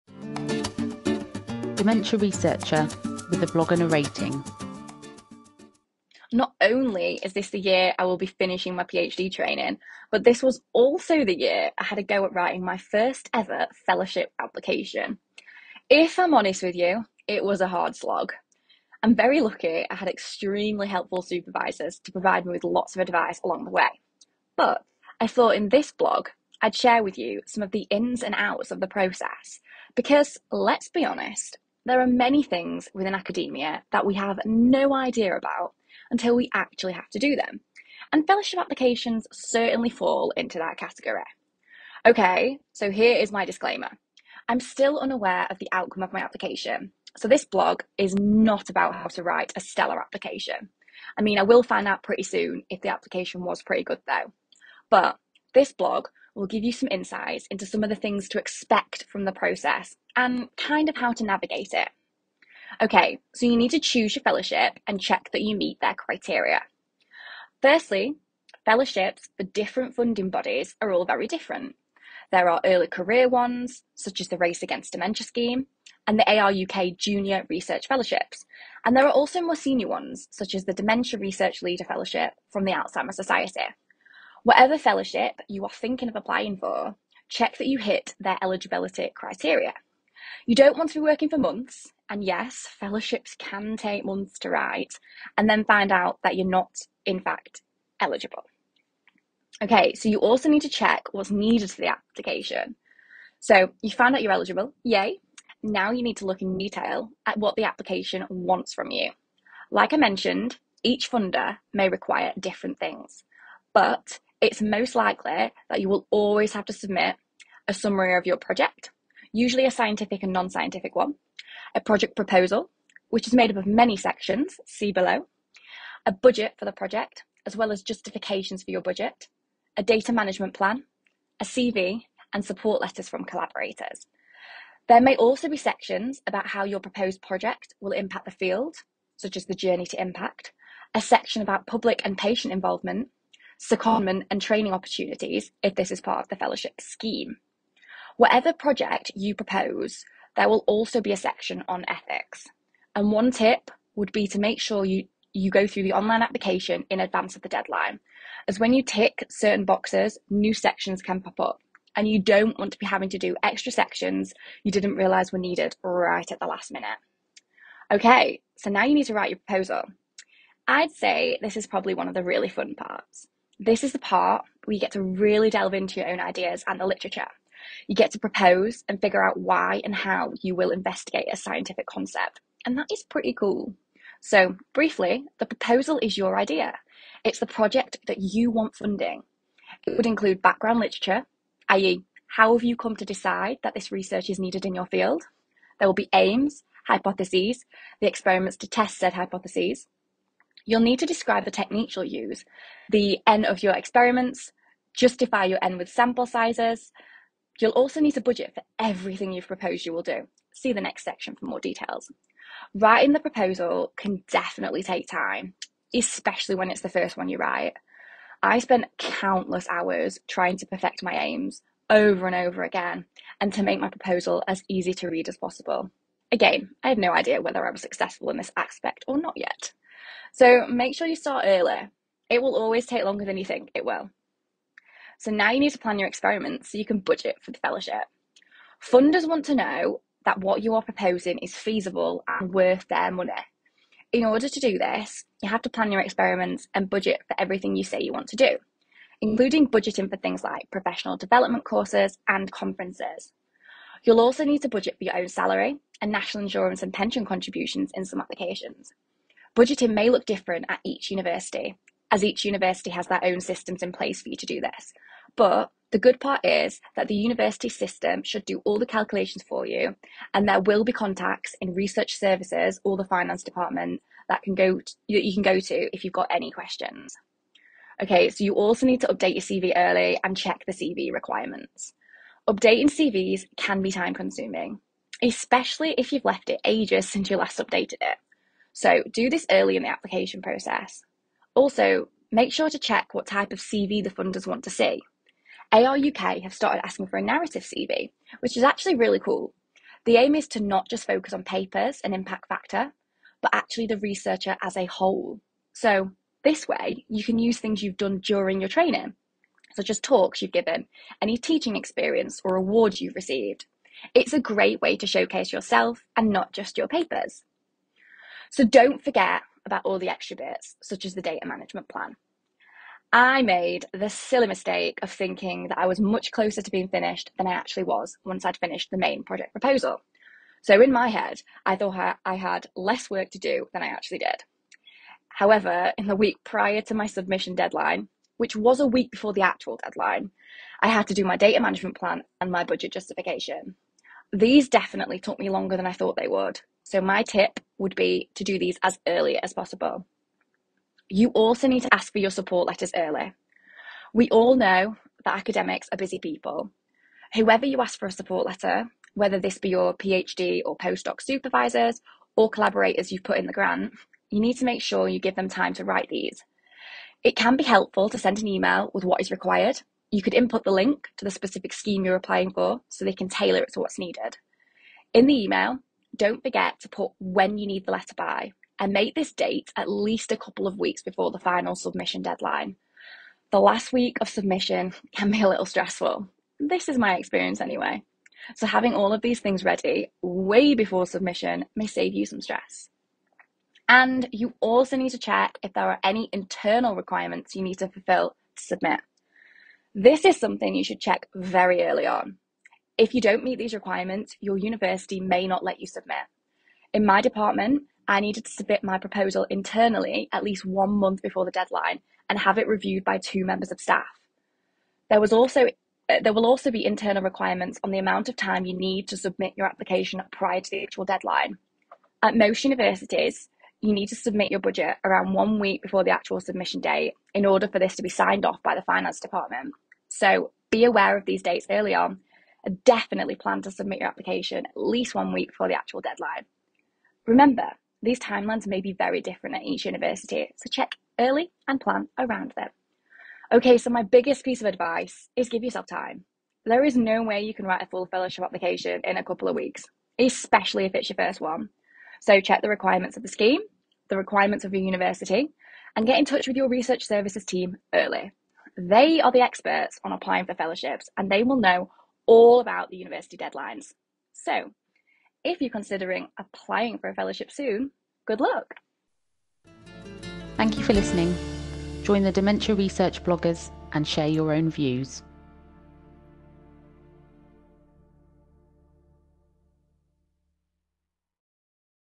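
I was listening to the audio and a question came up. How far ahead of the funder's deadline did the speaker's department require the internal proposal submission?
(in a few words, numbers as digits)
One month.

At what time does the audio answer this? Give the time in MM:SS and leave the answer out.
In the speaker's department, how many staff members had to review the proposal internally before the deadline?
06:53.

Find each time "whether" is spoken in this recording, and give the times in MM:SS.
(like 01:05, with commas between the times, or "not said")
03:47, 05:59.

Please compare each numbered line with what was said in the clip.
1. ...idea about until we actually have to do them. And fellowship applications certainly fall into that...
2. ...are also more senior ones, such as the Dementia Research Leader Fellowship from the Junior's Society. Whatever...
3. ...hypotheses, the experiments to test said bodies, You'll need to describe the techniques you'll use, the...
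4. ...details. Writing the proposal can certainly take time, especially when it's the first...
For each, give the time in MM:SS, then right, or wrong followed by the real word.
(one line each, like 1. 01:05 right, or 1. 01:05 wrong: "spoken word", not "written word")
1. 00:34 right
2. 01:19 wrong: "Alzheimer", not "Junior"
3. 03:16 wrong: "hypotheses", not "bodies"
4. 03:31 wrong: "definitely", not "certainly".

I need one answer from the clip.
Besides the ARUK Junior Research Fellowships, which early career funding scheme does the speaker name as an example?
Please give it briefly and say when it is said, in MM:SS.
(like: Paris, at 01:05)
Race Against Dementia, at 01:14.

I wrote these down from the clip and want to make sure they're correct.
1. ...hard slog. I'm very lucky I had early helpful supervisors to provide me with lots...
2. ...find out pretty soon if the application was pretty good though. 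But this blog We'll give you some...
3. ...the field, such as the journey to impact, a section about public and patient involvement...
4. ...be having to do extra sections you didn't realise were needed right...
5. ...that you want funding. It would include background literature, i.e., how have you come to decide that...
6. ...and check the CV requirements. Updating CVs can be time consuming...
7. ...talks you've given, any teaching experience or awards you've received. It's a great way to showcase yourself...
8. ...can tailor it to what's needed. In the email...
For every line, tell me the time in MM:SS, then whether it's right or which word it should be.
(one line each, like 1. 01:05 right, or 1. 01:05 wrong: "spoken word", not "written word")
1. 00:17 wrong: "extremely", not "early"
2. 00:51 right
3. 02:18 right
4. 02:42 right
5. 03:08 right
6. 04:40 right
7. 05:09 right
8. 06:13 right.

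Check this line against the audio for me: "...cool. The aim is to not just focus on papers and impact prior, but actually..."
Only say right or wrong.
wrong.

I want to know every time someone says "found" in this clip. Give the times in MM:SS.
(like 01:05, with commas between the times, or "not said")
01:43.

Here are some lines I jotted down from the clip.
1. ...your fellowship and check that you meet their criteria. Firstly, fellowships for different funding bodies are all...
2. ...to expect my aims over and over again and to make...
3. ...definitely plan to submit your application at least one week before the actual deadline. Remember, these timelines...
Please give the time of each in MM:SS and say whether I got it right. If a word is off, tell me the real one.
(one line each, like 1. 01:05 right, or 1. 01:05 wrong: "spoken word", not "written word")
1. 01:04 right
2. 03:40 wrong: "perfect", not "expect"
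3. 07:12 right.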